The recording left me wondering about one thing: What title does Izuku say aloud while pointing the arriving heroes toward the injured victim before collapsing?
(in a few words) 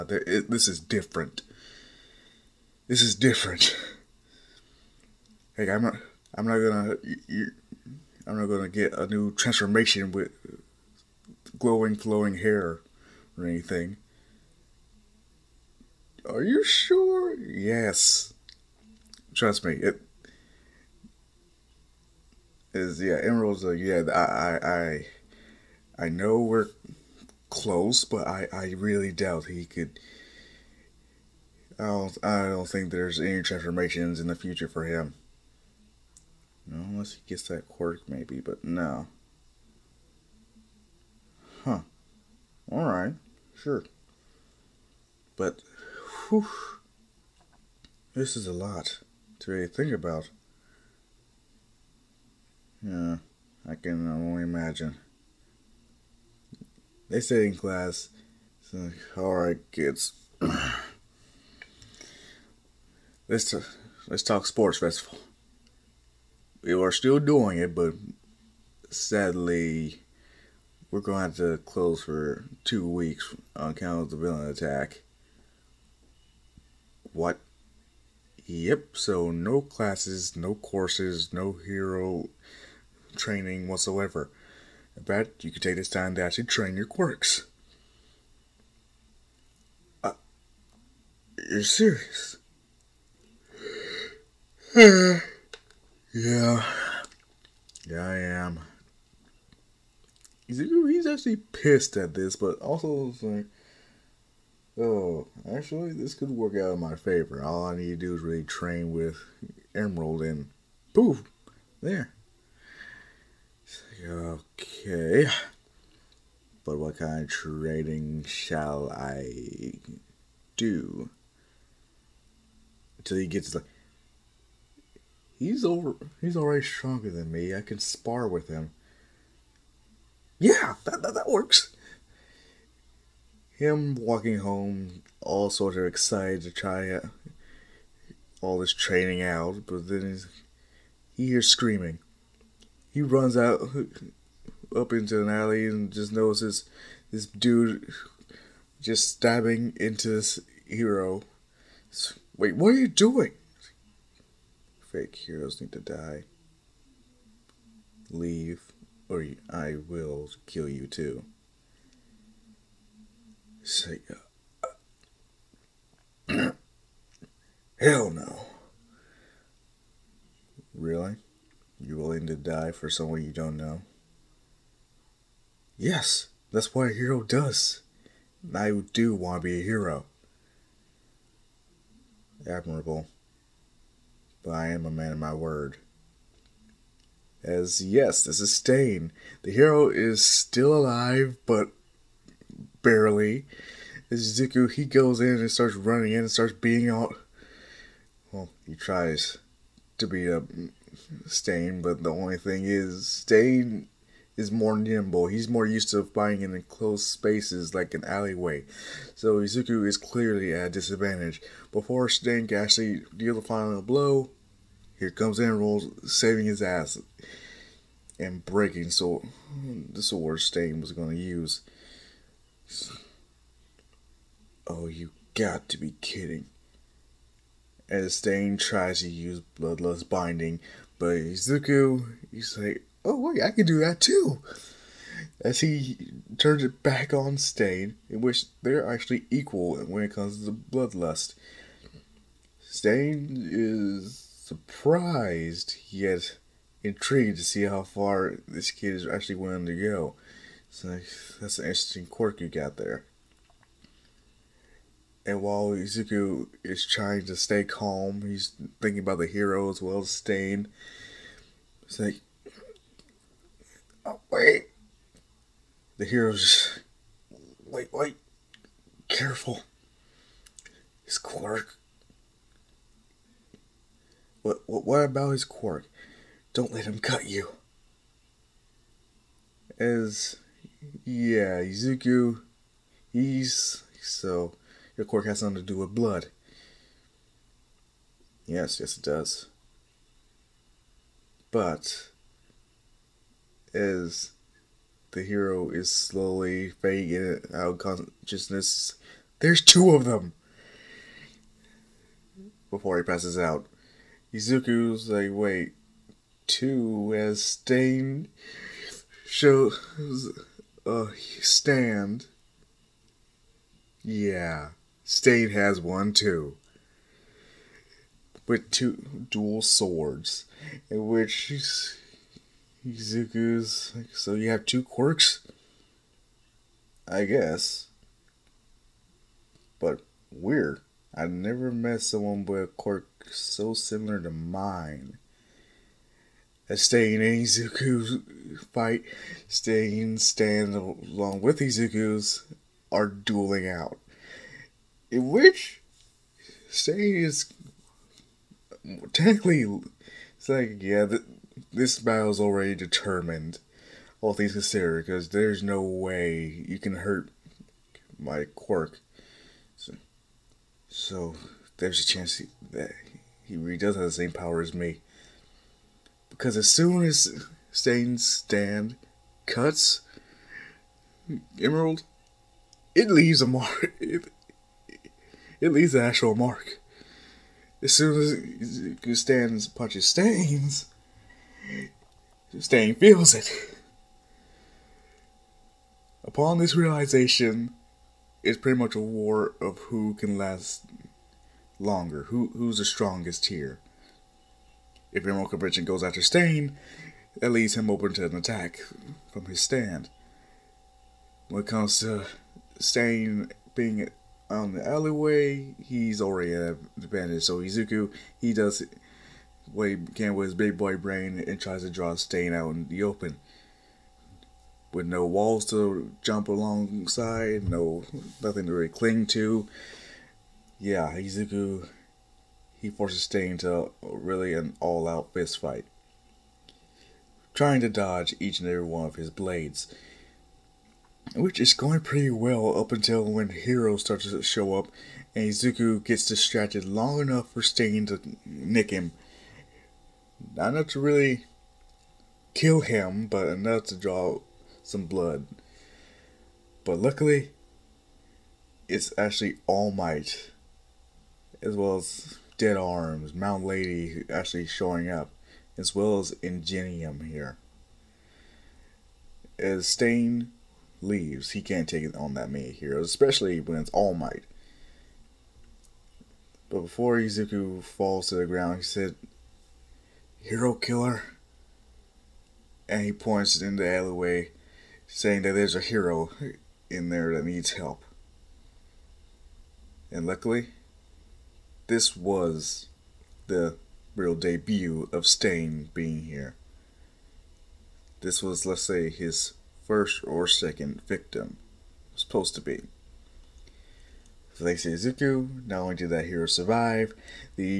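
Hero Killer.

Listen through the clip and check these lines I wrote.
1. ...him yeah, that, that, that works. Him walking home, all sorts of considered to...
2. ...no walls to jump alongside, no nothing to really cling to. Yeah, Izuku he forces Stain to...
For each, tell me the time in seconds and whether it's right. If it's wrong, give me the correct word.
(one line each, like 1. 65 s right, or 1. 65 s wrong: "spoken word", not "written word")
1. 128 s wrong: "excited", not "considered"
2. 415 s right.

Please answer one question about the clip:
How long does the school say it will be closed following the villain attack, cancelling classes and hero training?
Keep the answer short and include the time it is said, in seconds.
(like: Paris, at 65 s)
2 weeks, at 72 s.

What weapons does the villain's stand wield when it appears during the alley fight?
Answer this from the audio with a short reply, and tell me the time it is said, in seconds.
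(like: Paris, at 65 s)
Dual swords, at 318 s.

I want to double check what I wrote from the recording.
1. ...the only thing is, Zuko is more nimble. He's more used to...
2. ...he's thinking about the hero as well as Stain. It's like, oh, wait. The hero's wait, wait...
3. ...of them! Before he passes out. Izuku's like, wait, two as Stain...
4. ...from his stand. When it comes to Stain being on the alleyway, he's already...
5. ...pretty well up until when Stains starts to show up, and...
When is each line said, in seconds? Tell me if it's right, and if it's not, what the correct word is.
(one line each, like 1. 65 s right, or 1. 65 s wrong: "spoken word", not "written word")
1. 202 s wrong: "Stain", not "Zuko"
2. 258 s right
3. 299 s right
4. 399 s right
5. 432 s wrong: "Hero", not "Stains".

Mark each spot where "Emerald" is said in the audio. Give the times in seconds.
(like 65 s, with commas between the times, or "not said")
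23 s, 109 s, 371 s.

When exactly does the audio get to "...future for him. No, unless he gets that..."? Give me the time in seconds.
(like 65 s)
34 s.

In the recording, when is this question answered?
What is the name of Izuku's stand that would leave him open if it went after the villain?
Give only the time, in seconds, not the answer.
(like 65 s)
395 s.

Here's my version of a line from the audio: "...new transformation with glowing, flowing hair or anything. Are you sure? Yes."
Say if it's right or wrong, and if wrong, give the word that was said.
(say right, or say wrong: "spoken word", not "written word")
right.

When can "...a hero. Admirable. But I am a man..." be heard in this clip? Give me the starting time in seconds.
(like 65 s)
179 s.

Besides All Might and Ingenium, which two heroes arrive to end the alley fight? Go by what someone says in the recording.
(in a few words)
Death Arms, Mount Lady.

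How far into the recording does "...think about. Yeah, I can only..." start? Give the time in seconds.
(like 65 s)
49 s.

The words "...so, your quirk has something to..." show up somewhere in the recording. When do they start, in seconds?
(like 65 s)
284 s.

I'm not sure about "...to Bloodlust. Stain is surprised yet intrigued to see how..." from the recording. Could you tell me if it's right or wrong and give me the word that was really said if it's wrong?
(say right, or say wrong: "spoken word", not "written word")
right.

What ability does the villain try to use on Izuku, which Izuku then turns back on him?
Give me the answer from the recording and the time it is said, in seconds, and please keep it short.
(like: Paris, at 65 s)
Bloodlust Binding, at 229 s.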